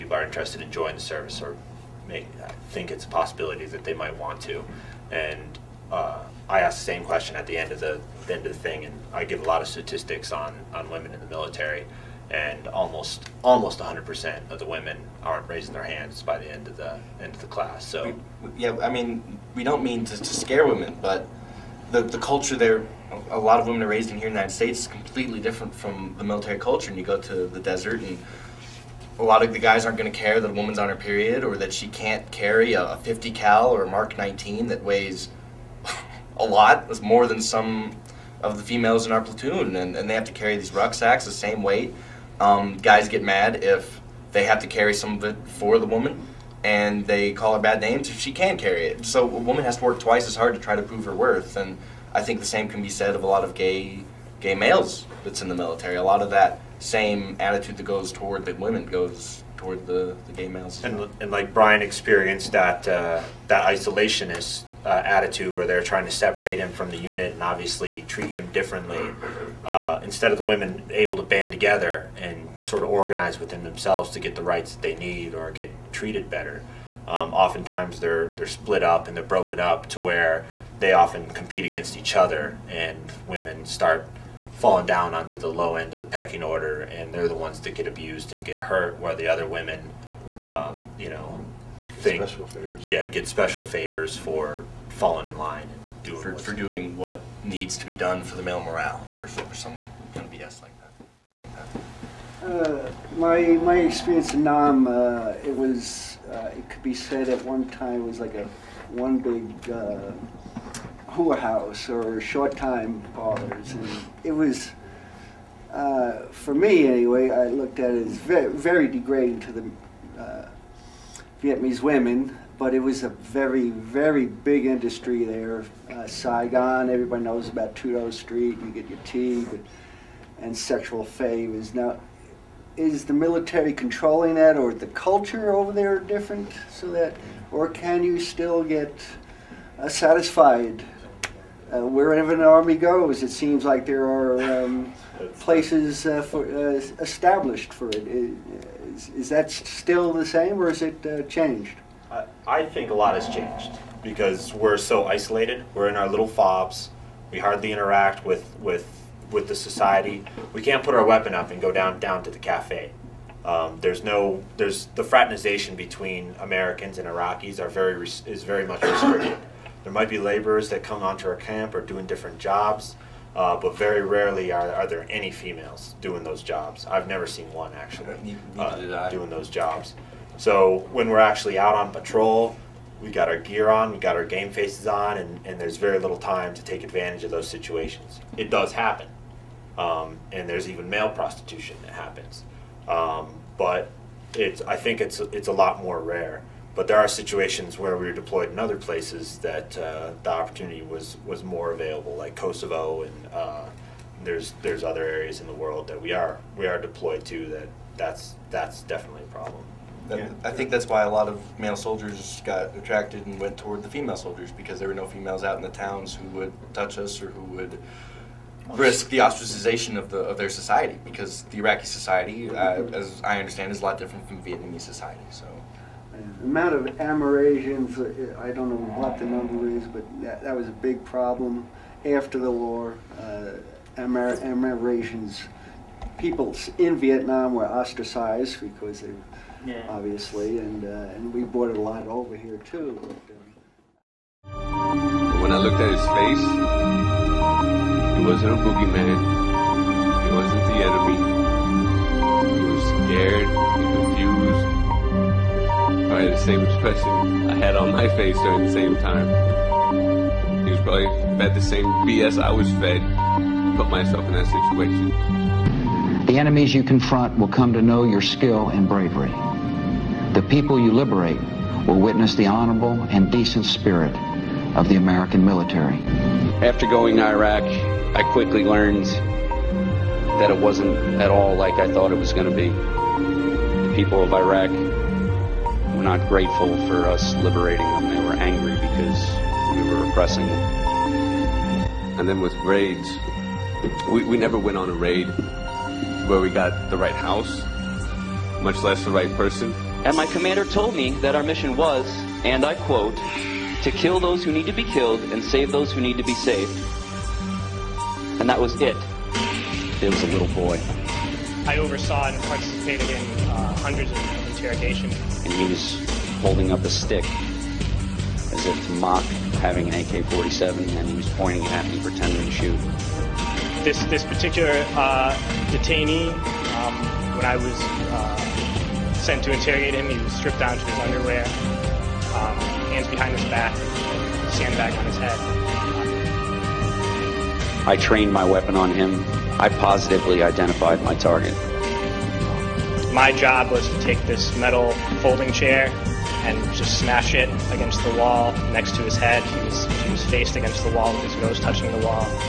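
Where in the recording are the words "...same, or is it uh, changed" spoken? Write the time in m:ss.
2:30.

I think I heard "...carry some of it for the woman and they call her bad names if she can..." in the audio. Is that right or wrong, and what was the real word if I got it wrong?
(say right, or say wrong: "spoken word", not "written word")
right.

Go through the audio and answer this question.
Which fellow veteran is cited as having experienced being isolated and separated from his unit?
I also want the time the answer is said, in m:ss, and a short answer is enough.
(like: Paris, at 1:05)
Brian, at 1:01.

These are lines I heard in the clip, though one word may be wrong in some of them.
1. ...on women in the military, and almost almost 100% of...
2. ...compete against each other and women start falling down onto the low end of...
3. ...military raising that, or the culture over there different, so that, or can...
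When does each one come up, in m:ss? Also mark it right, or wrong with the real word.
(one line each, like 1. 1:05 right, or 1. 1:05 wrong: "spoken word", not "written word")
1. 0:10 right
2. 1:21 right
3. 2:13 wrong: "controlling", not "raising".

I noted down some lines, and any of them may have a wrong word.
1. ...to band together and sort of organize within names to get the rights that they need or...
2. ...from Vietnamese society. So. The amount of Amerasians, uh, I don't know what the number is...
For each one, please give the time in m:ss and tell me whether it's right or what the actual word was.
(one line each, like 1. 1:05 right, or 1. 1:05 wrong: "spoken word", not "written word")
1. 1:11 wrong: "themselves", not "names"
2. 3:44 right.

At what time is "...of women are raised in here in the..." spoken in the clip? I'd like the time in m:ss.
0:23.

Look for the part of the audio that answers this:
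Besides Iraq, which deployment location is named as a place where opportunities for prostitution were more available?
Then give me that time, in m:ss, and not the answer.
3:22.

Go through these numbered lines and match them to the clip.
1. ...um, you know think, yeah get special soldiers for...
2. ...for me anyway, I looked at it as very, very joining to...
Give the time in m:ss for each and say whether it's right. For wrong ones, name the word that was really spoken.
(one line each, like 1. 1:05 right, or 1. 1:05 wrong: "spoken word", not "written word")
1. 1:30 wrong: "favors", not "soldiers"
2. 1:56 wrong: "degrading", not "joining".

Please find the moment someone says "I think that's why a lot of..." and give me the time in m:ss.
3:30.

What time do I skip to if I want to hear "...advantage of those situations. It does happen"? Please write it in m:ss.
3:06.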